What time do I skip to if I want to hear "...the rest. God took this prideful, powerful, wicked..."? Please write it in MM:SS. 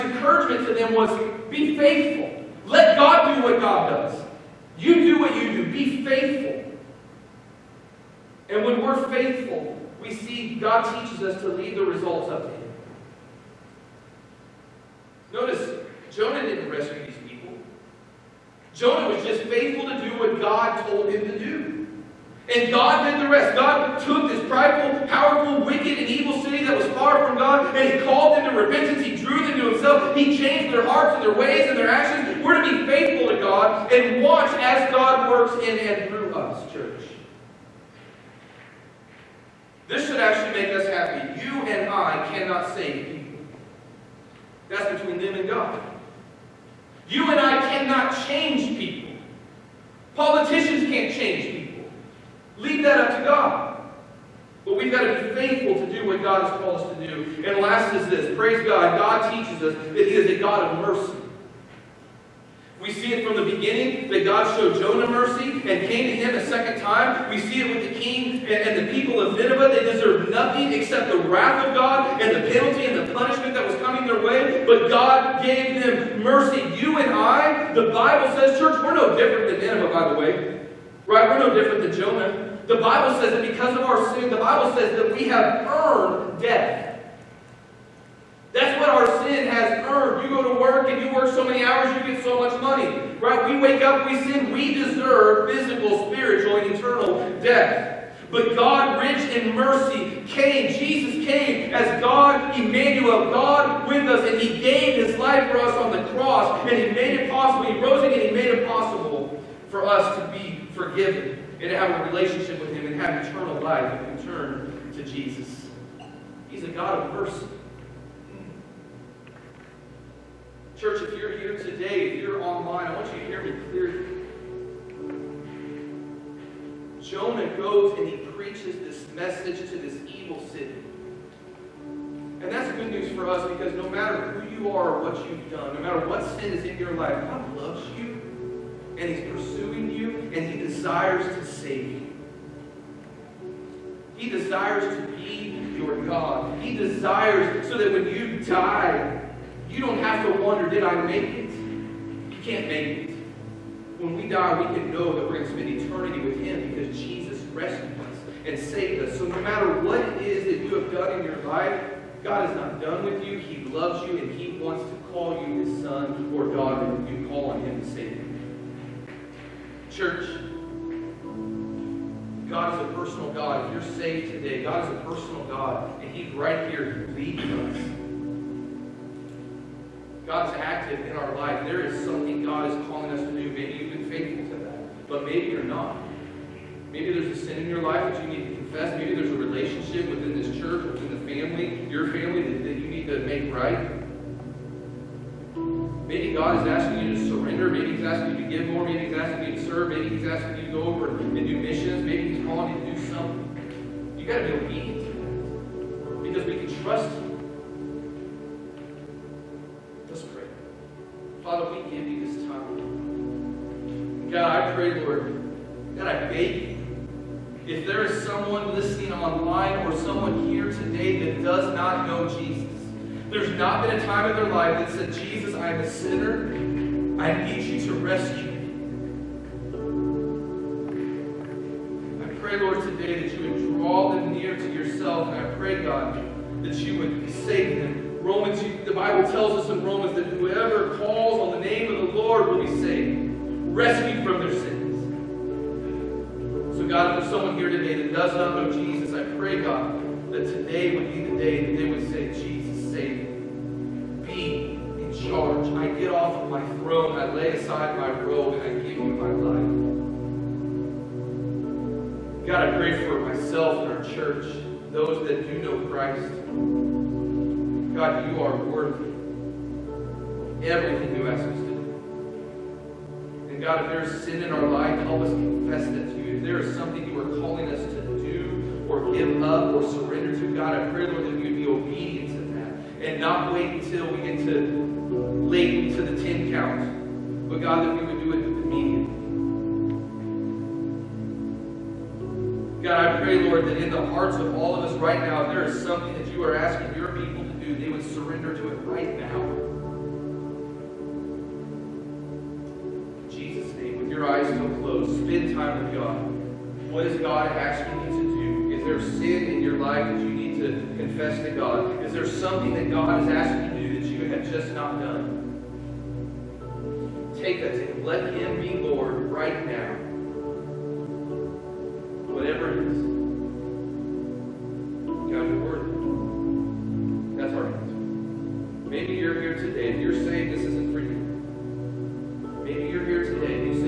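00:23.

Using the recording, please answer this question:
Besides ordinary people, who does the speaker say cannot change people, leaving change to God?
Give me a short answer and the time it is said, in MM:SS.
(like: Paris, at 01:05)
Politicians, at 00:50.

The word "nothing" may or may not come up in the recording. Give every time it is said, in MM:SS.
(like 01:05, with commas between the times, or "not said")
01:10.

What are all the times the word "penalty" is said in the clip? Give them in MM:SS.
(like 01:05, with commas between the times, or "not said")
01:12.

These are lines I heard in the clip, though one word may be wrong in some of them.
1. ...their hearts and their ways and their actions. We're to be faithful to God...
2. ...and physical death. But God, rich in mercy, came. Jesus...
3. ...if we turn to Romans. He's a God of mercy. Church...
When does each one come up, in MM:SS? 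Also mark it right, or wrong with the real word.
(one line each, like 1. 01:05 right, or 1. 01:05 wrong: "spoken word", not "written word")
1. 00:30 right
2. 01:36 wrong: "eternal", not "physical"
3. 01:53 wrong: "Jesus", not "Romans".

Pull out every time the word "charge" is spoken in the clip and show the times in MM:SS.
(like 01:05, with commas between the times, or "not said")
04:15.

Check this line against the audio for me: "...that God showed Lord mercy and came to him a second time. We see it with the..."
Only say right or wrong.
wrong.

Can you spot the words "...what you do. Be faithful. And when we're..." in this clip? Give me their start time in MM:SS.
00:05.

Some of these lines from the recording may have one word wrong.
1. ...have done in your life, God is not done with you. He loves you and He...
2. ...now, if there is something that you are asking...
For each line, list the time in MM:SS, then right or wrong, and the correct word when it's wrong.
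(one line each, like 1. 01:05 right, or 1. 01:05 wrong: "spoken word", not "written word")
1. 02:40 right
2. 04:55 right.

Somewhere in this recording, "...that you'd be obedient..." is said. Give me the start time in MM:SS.
04:41.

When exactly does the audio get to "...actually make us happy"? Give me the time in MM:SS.
00:40.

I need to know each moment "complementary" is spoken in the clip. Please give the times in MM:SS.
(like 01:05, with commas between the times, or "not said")
not said.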